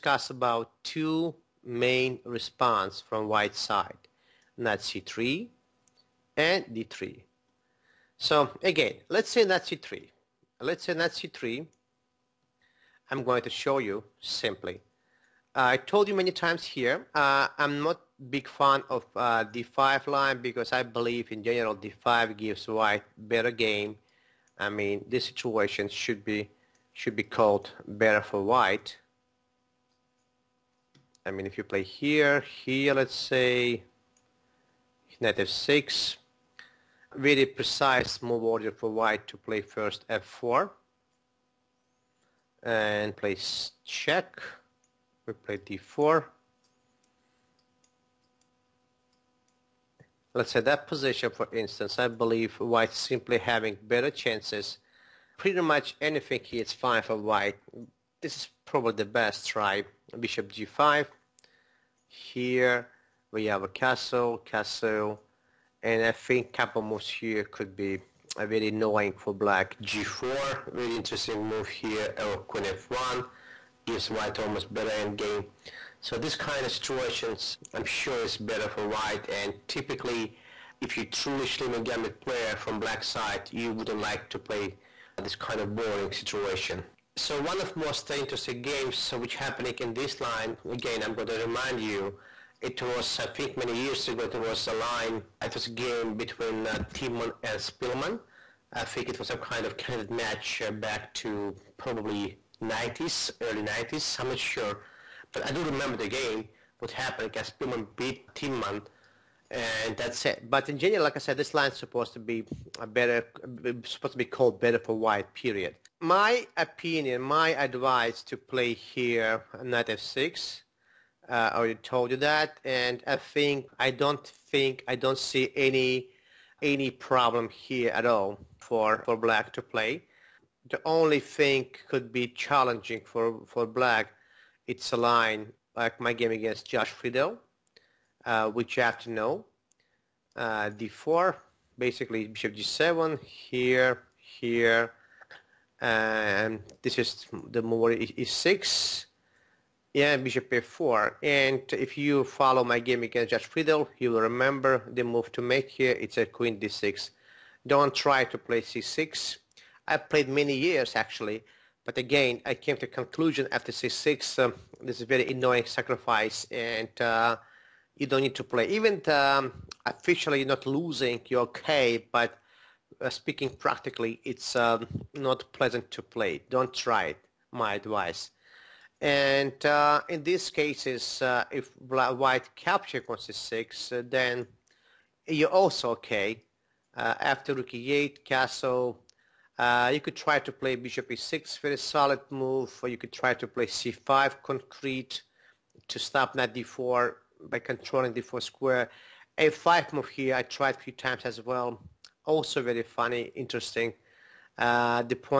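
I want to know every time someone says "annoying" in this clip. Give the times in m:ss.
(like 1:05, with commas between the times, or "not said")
1:08, 2:45.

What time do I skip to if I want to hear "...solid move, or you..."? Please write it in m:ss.
3:11.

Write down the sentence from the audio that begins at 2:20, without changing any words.
Uh, d4, basically bishop g7, here, here, and this is the move e6, yeah, bishop a4.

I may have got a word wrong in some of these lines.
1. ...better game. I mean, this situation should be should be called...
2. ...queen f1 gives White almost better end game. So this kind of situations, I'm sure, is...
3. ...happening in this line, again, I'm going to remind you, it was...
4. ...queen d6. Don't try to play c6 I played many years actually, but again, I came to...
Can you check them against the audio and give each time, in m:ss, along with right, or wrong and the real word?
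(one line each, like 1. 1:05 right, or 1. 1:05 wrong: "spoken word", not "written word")
1. 0:23 right
2. 1:12 right
3. 1:29 right
4. 2:36 right.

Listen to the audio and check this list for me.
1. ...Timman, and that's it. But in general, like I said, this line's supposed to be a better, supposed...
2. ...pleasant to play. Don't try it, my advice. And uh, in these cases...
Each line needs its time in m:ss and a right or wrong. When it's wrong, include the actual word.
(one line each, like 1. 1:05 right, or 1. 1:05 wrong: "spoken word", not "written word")
1. 1:48 right
2. 2:55 right.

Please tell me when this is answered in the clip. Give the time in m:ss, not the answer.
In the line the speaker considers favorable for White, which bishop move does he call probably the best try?
1:00.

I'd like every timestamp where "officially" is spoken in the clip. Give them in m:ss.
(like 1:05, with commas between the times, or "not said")
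2:49.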